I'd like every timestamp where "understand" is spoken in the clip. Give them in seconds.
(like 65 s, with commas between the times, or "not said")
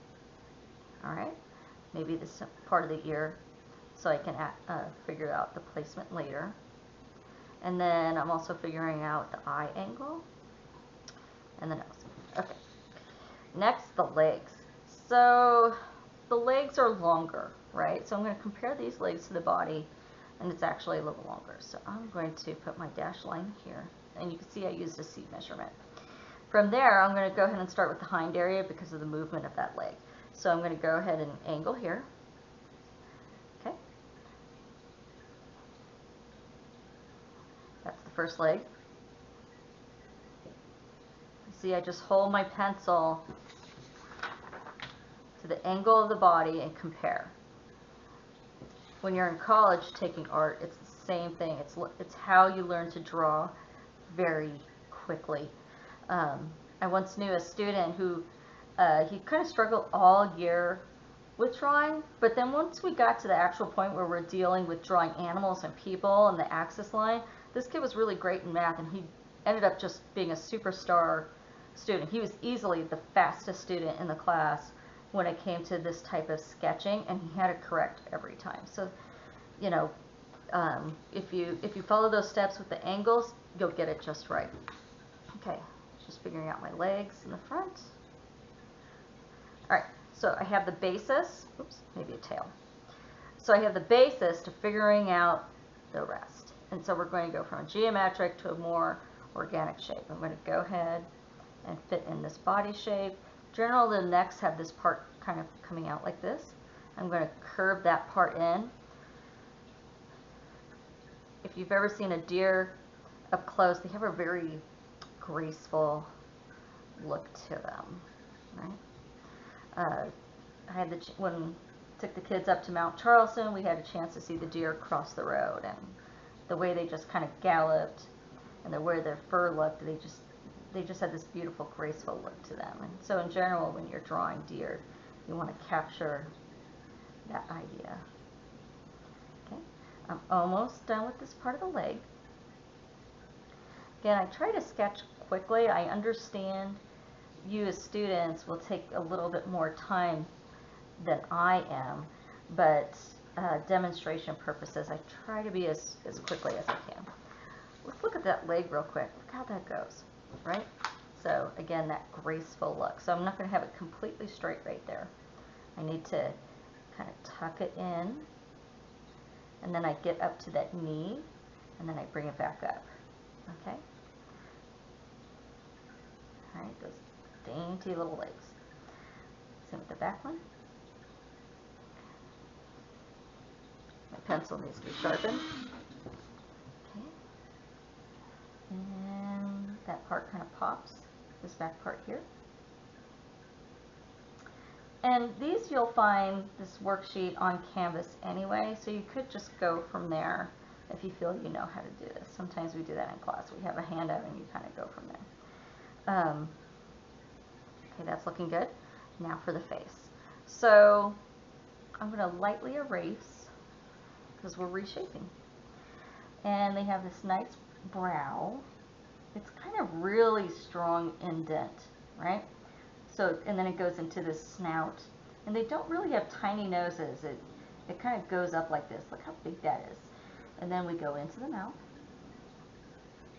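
145 s.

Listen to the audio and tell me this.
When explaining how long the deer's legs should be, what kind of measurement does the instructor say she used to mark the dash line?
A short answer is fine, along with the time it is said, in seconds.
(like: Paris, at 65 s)
seat measurement, at 25 s.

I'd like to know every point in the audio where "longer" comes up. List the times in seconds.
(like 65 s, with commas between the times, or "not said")
16 s, 21 s.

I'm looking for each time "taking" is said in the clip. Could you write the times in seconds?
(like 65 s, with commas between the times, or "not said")
49 s.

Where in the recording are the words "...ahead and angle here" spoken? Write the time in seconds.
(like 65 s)
30 s.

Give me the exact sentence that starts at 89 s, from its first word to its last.
All right, so I have the basis, oops, maybe a tail.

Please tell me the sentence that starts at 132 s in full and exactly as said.
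And so in general, when you're drawing deer, you want to capture that idea.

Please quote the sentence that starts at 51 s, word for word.
It's, it's how you learn to draw very quickly.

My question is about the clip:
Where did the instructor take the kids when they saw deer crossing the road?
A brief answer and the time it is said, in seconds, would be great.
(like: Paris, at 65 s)
Mount Charleston, at 122 s.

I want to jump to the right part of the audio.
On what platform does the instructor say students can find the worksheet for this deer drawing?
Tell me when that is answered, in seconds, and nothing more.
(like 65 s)
197 s.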